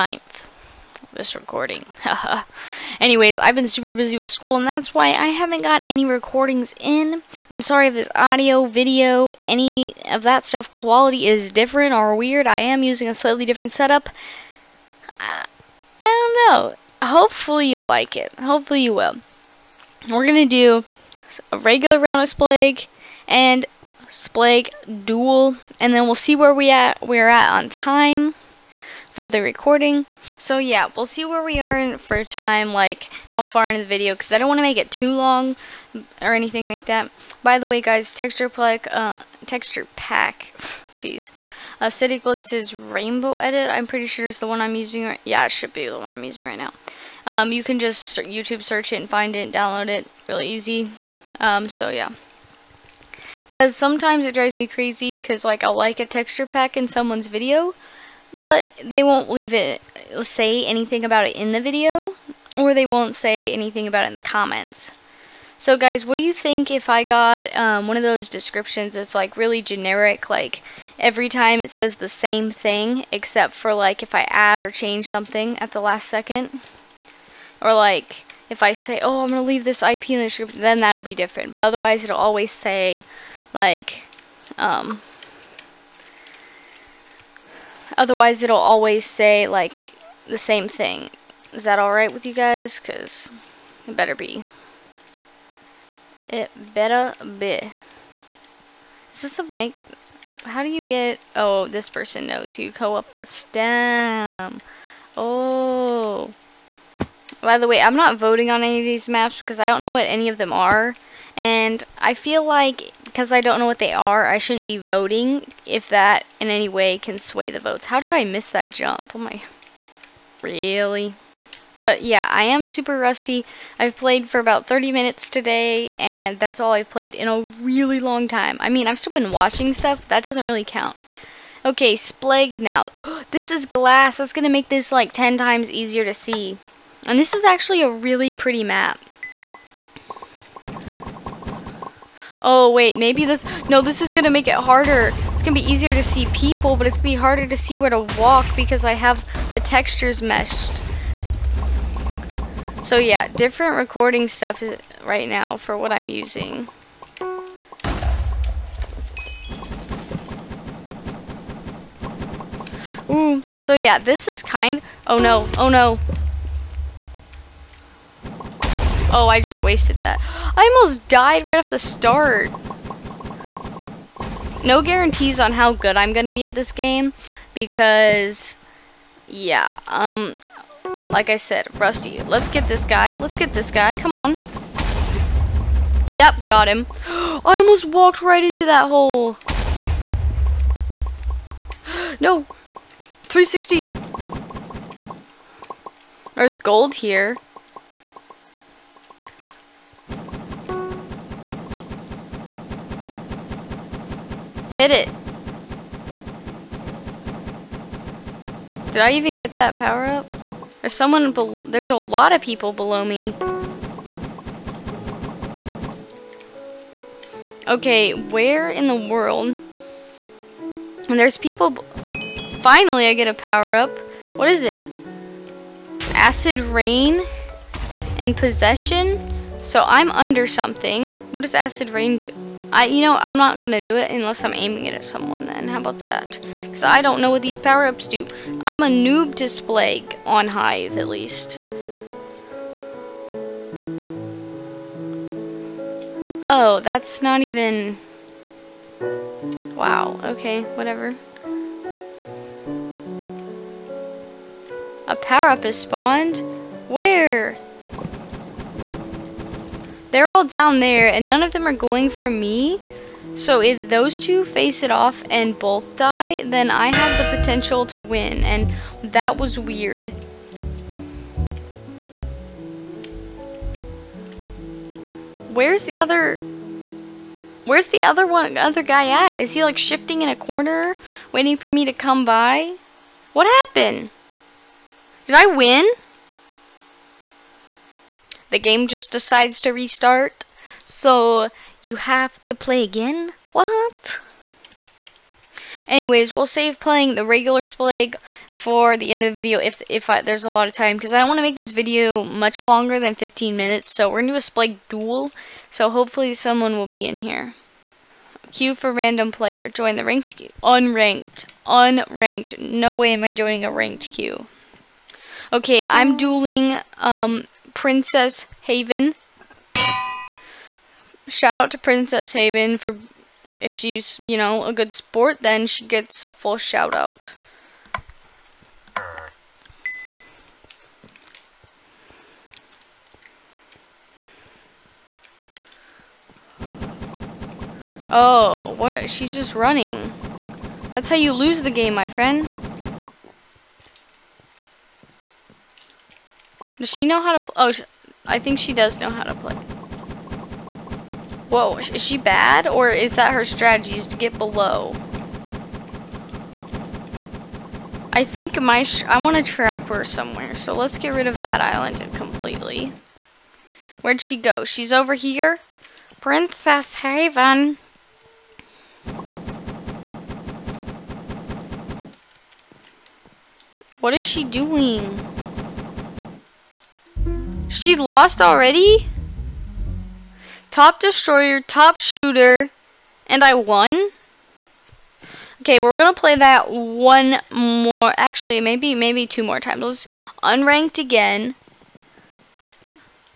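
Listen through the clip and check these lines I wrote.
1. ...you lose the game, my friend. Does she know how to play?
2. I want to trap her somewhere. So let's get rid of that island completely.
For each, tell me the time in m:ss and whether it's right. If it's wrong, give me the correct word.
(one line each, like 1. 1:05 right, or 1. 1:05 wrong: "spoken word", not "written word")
1. 5:41 right
2. 5:59 right.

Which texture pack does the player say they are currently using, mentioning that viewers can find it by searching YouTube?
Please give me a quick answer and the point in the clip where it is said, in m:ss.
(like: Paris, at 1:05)
AciDicBliTzz's Rainbow Edit, at 0:41.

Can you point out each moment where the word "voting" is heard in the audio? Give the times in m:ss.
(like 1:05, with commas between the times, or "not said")
1:48, 1:54.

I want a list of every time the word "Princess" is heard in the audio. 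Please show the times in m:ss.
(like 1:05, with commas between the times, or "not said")
5:17, 5:21, 6:06.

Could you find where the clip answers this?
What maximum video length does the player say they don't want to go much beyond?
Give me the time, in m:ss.
5:03.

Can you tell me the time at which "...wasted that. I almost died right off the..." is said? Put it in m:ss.
2:49.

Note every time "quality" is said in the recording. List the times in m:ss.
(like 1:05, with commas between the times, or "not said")
0:10.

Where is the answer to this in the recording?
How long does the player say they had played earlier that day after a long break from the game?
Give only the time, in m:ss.
2:04.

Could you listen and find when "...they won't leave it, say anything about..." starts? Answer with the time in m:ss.
0:58.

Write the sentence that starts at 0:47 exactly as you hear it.
Um, you can just YouTube search it and find it, download it, really easy.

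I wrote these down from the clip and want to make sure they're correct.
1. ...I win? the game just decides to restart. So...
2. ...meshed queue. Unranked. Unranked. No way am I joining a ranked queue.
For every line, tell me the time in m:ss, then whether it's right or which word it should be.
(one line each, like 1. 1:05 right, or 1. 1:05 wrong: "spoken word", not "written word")
1. 4:45 right
2. 5:10 wrong: "ranked", not "meshed".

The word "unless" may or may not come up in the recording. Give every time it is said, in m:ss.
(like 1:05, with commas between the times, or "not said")
3:54.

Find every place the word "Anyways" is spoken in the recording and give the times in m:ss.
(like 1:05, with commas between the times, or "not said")
0:03, 4:55.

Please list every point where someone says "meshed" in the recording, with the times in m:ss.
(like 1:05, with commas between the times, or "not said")
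2:30.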